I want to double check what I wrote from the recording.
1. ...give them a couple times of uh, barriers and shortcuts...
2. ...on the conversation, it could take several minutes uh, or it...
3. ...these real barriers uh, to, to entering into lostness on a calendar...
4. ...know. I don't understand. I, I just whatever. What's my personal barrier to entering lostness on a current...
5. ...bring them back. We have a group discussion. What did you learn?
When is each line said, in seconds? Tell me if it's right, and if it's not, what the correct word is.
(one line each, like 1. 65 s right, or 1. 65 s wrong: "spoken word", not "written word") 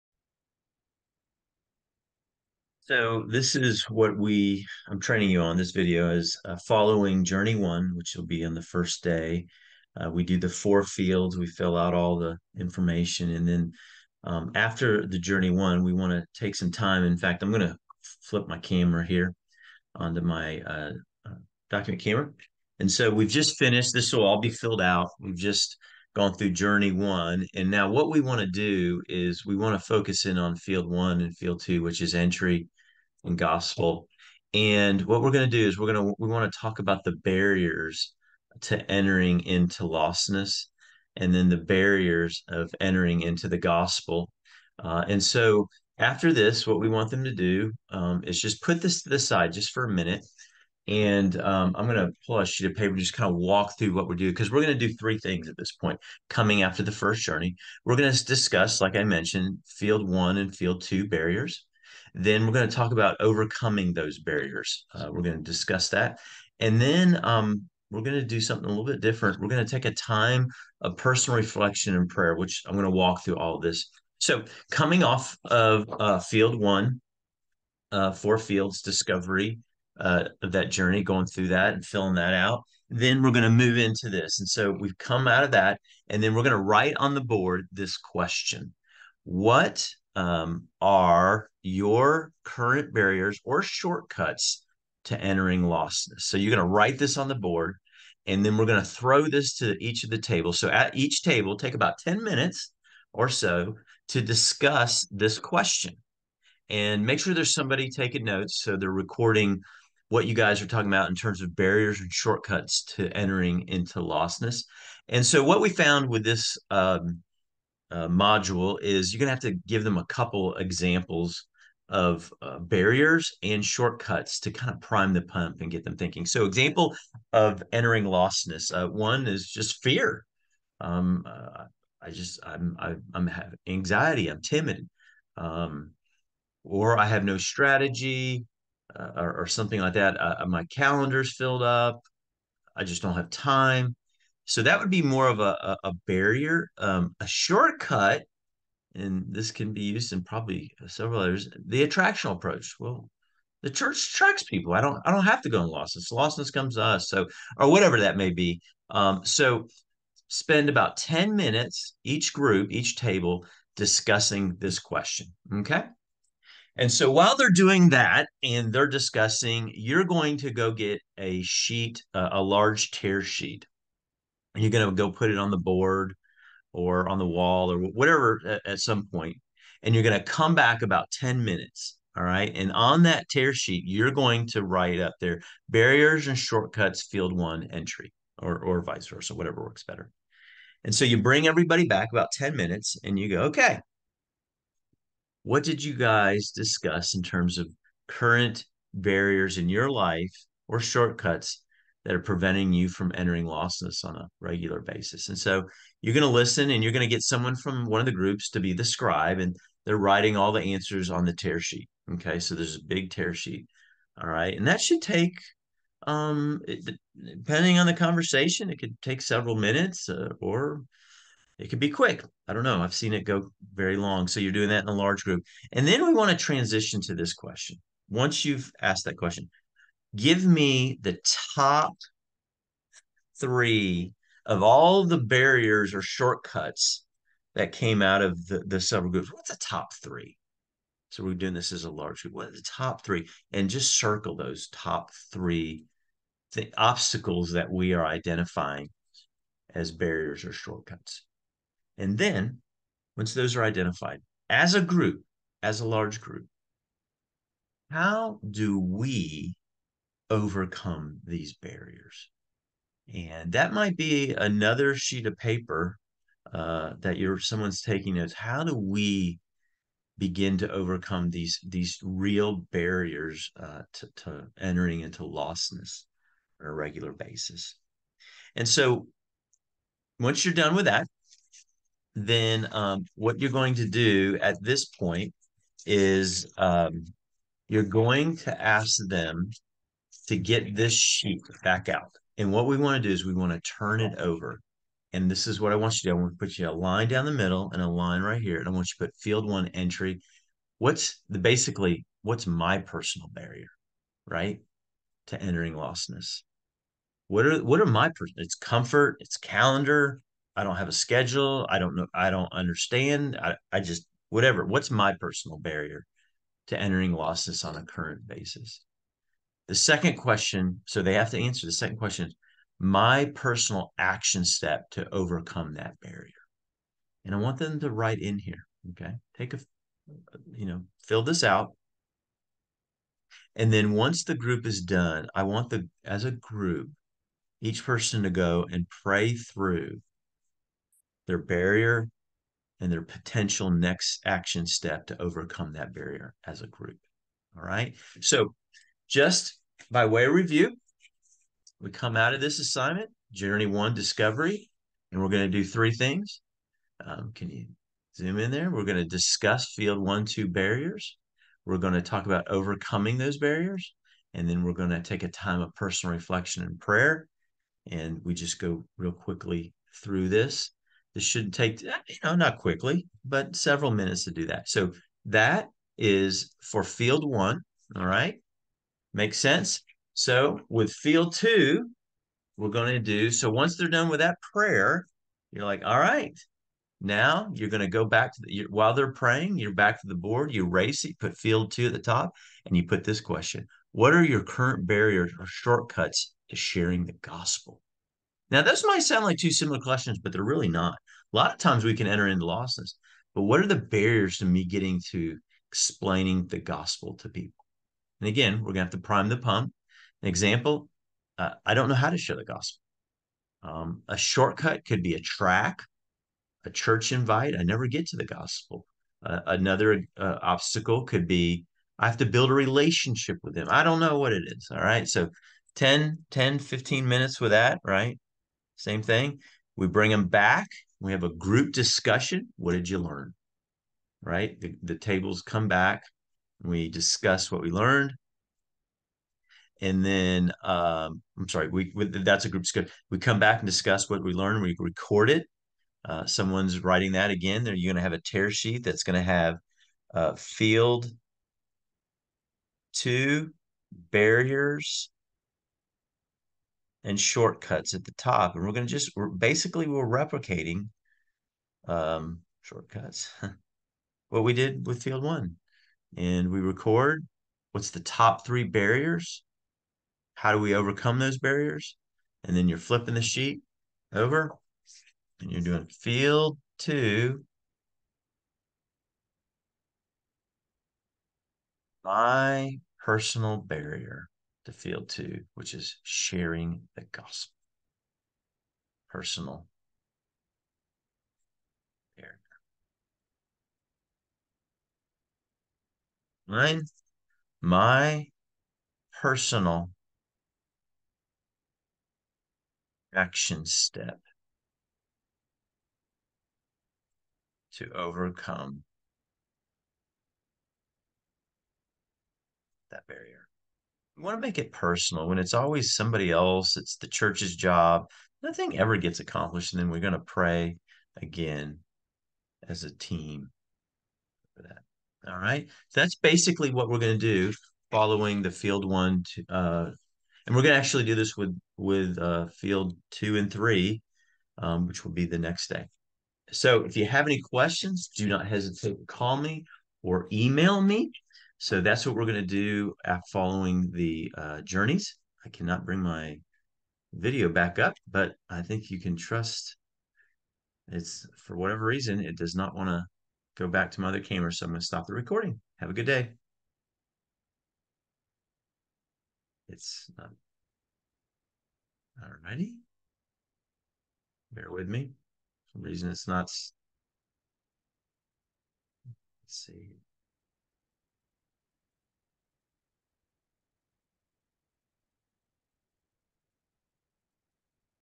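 1. 119 s wrong: "examples", not "times"
2. 217 s right
3. 271 s wrong: "regular", not "calendar"
4. 311 s right
5. 429 s right.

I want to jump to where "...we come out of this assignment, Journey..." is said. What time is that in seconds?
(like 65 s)
351 s.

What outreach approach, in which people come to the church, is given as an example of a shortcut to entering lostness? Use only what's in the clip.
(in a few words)
Attractional approach.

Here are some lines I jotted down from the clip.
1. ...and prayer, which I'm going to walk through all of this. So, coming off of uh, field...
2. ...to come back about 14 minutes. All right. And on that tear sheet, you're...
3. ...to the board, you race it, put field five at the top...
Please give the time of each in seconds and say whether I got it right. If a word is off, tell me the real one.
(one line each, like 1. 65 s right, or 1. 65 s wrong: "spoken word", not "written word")
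1. 71 s right
2. 180 s wrong: "10", not "14"
3. 390 s wrong: "two", not "five".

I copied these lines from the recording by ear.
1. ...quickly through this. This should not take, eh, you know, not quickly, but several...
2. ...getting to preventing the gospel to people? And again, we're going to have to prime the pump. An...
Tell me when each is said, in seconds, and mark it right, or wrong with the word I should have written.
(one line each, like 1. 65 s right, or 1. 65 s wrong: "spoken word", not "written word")
1. 369 s right
2. 404 s wrong: "explaining", not "preventing".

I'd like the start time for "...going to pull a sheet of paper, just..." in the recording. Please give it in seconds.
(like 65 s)
51 s.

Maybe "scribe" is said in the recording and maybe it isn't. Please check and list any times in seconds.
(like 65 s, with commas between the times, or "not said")
208 s.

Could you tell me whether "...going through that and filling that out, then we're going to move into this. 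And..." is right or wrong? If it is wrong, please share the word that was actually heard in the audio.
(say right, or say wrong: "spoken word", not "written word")
right.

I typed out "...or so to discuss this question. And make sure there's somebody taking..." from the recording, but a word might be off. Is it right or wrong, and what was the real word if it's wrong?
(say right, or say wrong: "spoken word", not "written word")
right.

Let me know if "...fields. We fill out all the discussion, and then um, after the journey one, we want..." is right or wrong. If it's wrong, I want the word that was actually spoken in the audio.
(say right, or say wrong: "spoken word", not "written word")
wrong: "information", not "discussion".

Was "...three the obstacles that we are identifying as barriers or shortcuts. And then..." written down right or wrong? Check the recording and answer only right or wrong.
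right.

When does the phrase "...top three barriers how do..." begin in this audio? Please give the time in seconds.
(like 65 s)
467 s.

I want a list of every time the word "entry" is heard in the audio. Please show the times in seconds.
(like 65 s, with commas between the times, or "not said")
32 s, 187 s, 299 s.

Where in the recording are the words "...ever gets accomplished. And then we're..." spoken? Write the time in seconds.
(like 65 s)
518 s.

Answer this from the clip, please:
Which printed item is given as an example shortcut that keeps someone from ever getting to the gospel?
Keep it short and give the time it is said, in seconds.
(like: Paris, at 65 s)
A tract, at 415 s.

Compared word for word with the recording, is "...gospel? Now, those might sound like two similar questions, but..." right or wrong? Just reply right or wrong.
right.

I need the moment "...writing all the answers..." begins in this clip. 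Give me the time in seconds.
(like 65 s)
209 s.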